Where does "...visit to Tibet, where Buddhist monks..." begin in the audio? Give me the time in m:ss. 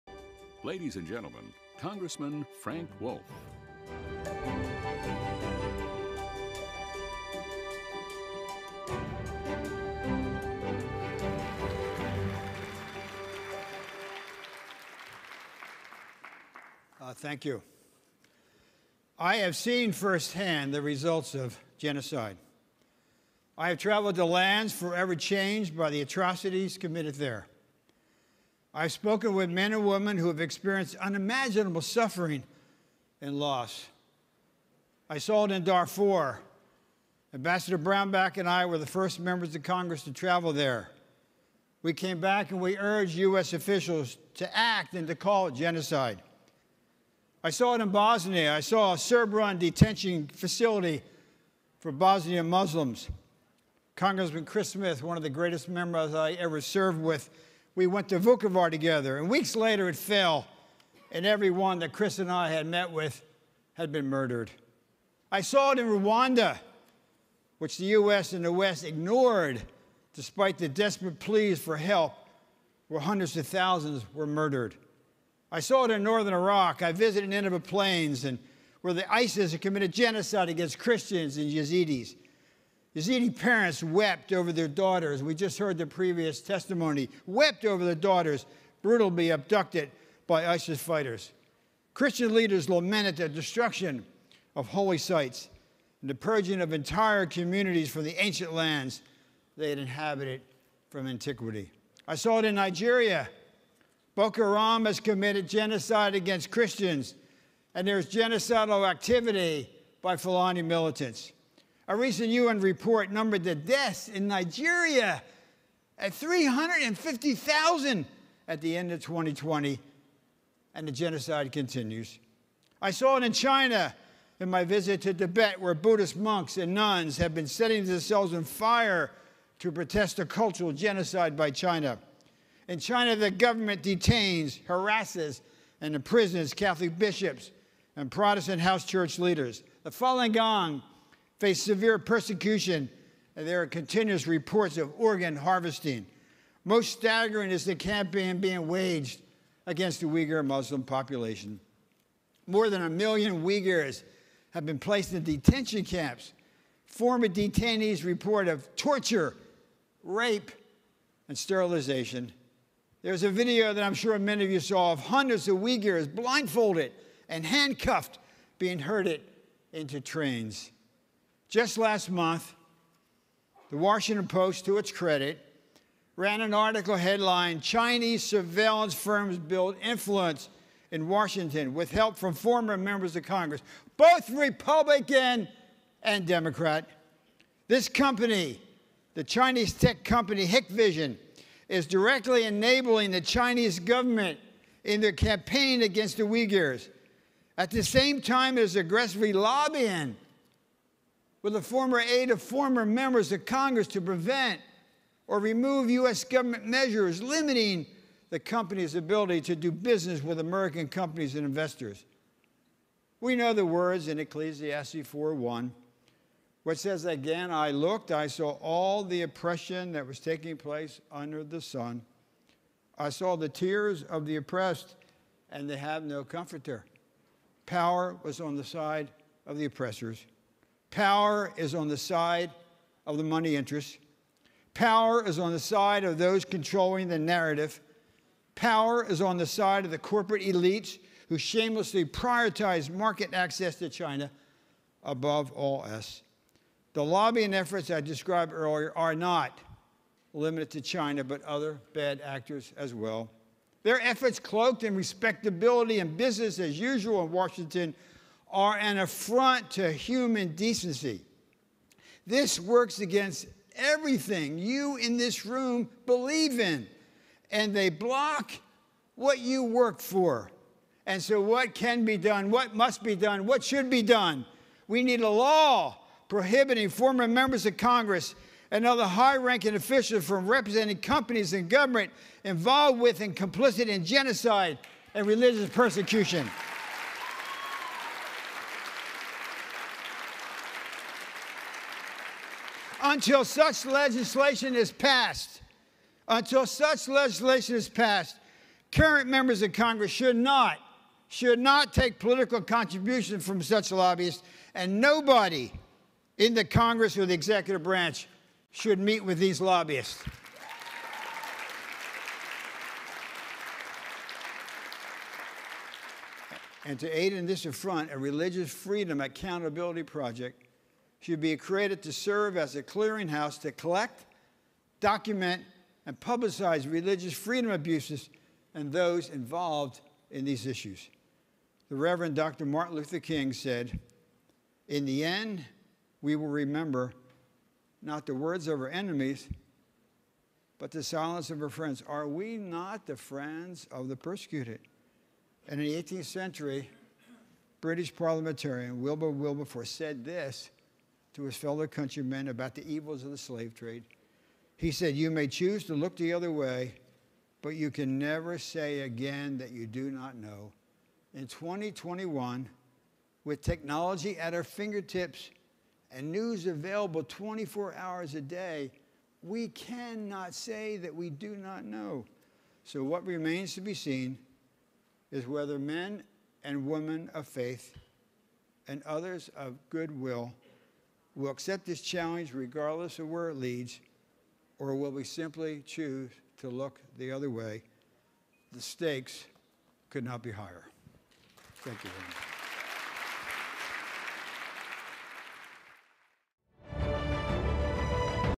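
2:04.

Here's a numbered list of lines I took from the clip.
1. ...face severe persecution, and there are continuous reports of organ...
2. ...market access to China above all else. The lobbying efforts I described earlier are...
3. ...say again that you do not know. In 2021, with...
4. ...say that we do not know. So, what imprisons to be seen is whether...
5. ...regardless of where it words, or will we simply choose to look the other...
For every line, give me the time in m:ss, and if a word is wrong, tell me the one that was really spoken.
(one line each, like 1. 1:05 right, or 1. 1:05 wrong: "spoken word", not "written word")
1. 2:21 right
2. 4:02 right
3. 5:58 right
4. 6:10 wrong: "remains", not "imprisons"
5. 6:22 wrong: "leads", not "words".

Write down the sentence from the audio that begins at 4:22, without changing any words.
This works against everything you in this room believe in, and they block what you work for.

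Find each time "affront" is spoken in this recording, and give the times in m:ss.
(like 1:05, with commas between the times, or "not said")
4:18, 5:17.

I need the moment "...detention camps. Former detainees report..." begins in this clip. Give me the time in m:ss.
2:35.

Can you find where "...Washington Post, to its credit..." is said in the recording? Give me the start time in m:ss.
2:53.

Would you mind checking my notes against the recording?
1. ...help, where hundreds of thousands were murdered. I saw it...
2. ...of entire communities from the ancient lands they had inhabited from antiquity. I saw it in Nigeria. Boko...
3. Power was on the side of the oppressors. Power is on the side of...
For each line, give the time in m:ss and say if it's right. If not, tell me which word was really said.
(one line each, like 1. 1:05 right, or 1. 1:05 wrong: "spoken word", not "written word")
1. 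1:11 right
2. 1:36 right
3. 3:47 right.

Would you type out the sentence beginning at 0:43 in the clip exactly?
officials to act and to call it genocide.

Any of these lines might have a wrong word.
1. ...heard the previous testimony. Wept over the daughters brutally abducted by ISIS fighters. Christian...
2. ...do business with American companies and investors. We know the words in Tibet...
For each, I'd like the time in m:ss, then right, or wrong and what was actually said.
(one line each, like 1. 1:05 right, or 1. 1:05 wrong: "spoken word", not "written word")
1. 1:25 right
2. 3:29 wrong: "Ecclesiastes", not "Tibet".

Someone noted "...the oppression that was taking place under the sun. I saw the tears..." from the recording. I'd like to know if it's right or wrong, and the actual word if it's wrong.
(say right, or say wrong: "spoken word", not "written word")
right.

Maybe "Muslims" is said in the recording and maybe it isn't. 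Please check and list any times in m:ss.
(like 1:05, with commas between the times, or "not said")
0:52, 2:30.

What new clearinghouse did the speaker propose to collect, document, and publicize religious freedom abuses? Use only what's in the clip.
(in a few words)
Religious Freedom Accountability Project.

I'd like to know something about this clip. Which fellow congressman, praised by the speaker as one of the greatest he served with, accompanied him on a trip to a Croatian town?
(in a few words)
Chris Smith.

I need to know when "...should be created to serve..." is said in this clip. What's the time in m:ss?
5:21.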